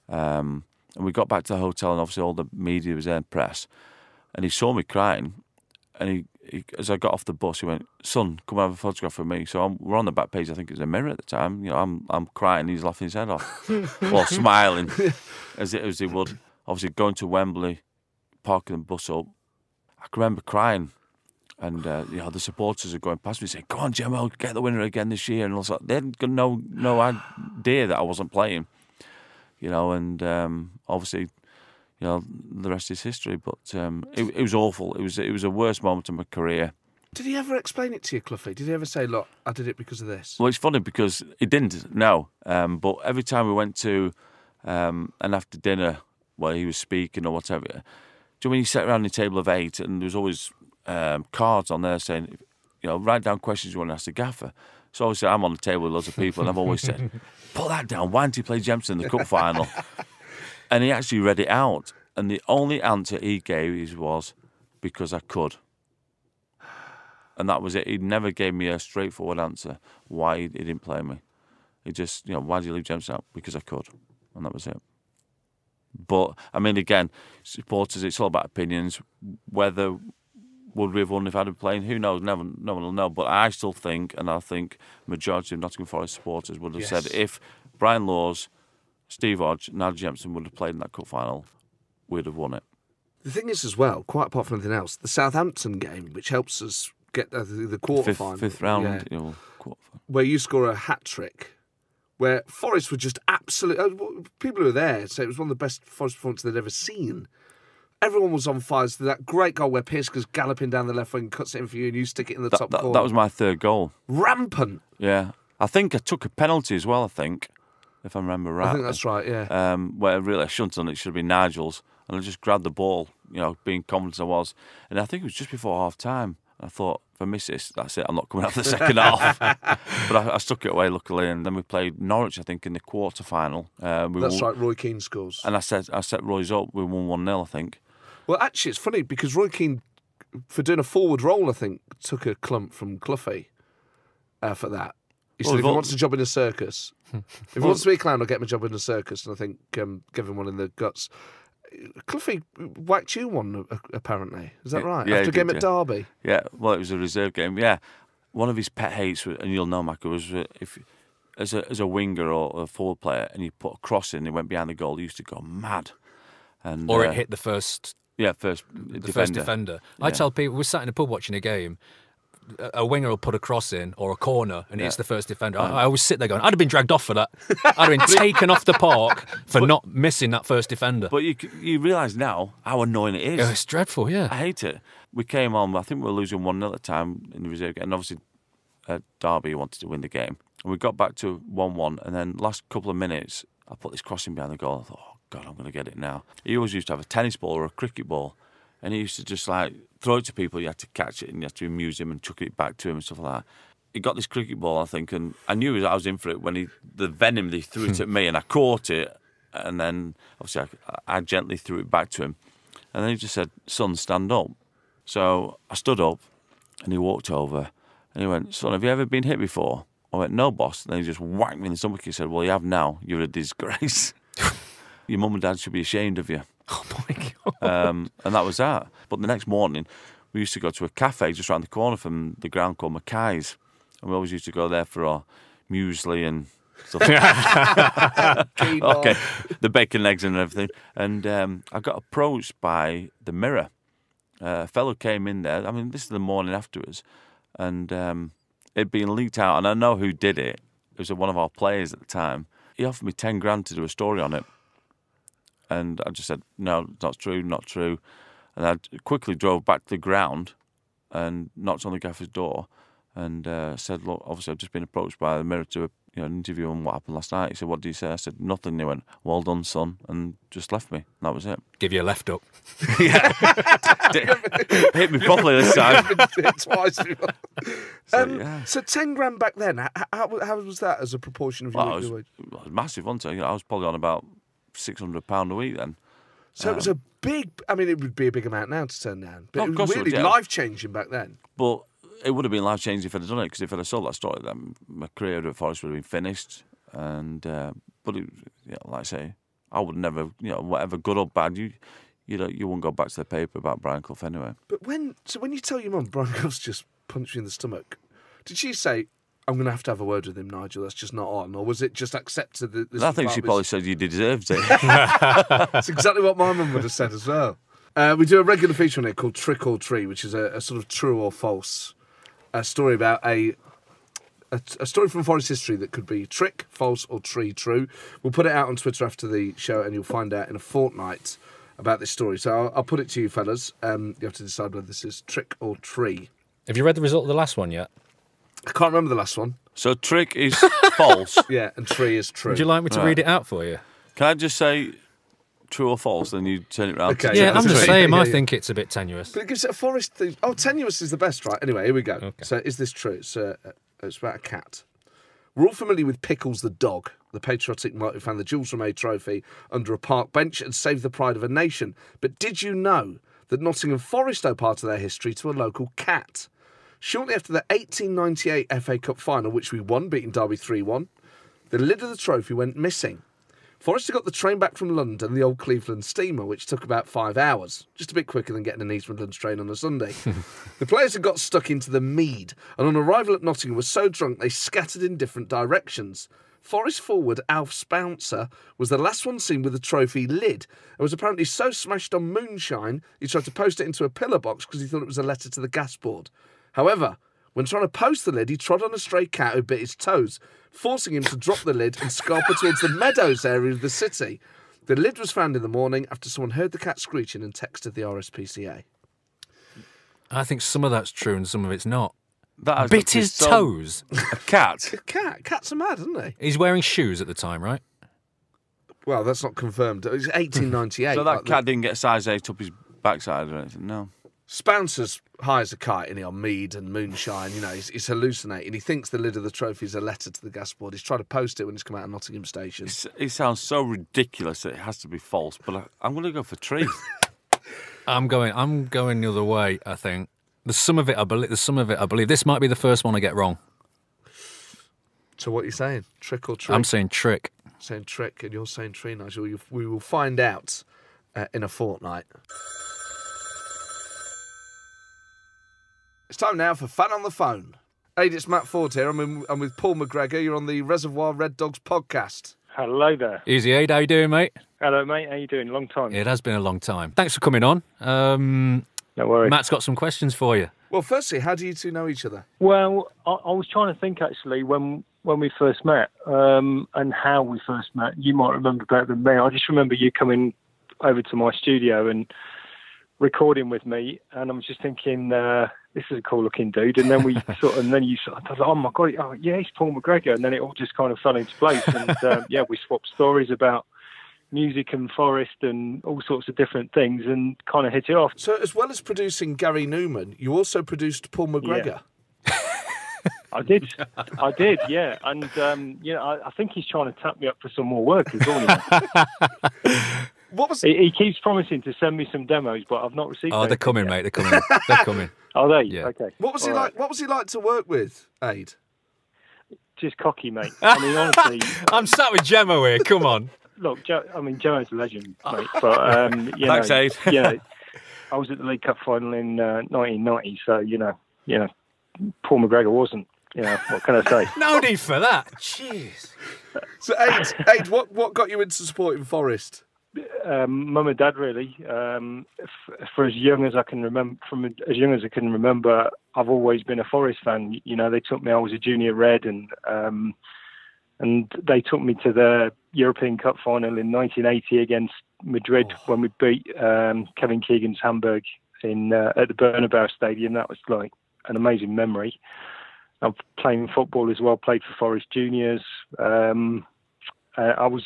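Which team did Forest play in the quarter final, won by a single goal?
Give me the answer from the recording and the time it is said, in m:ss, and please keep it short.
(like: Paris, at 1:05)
Norwich, at 2:12.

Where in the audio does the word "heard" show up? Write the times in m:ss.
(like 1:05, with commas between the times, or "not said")
6:46.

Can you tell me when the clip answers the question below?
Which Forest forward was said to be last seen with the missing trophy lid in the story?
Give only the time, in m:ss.
6:27.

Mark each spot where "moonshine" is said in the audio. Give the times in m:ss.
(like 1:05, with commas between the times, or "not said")
6:32, 7:06.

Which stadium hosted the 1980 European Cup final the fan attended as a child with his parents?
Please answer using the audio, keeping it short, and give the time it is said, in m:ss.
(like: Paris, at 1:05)
Bernabeu, at 9:19.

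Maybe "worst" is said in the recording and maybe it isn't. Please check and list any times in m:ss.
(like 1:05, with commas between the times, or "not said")
0:35.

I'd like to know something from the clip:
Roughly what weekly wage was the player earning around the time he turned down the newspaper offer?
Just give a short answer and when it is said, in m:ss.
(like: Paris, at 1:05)
£600 a week, at 4:44.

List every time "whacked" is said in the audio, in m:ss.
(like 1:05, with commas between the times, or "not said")
2:32, 3:41.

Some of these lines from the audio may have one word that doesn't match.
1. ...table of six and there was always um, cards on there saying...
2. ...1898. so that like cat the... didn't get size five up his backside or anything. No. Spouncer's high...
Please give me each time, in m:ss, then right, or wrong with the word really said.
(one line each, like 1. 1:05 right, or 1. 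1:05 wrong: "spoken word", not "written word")
1. 0:49 wrong: "eight", not "six"
2. 7:00 wrong: "eight", not "five".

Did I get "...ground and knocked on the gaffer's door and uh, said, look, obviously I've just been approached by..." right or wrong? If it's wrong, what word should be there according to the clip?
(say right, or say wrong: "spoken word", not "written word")
right.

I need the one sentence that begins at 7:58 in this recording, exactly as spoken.
You might remember better than me.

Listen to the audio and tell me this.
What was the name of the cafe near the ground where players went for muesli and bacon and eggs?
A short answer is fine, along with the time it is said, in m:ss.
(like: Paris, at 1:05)
Mackay's, at 3:52.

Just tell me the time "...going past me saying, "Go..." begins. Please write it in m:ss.
0:22.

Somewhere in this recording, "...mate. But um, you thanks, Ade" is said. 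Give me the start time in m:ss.
8:45.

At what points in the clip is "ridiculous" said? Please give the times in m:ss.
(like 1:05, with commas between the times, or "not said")
7:13.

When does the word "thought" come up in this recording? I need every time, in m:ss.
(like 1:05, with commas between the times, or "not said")
2:06, 3:14, 6:34.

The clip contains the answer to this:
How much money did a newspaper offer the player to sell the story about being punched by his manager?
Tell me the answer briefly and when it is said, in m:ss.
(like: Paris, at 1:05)
10 grand, at 4:13.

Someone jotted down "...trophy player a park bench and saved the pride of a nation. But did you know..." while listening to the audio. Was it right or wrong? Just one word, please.
wrong.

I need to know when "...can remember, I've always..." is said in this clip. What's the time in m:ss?
9:05.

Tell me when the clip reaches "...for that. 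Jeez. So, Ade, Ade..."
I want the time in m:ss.
8:55.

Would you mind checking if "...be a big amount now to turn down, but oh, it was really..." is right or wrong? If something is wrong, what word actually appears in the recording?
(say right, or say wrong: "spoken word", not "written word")
right.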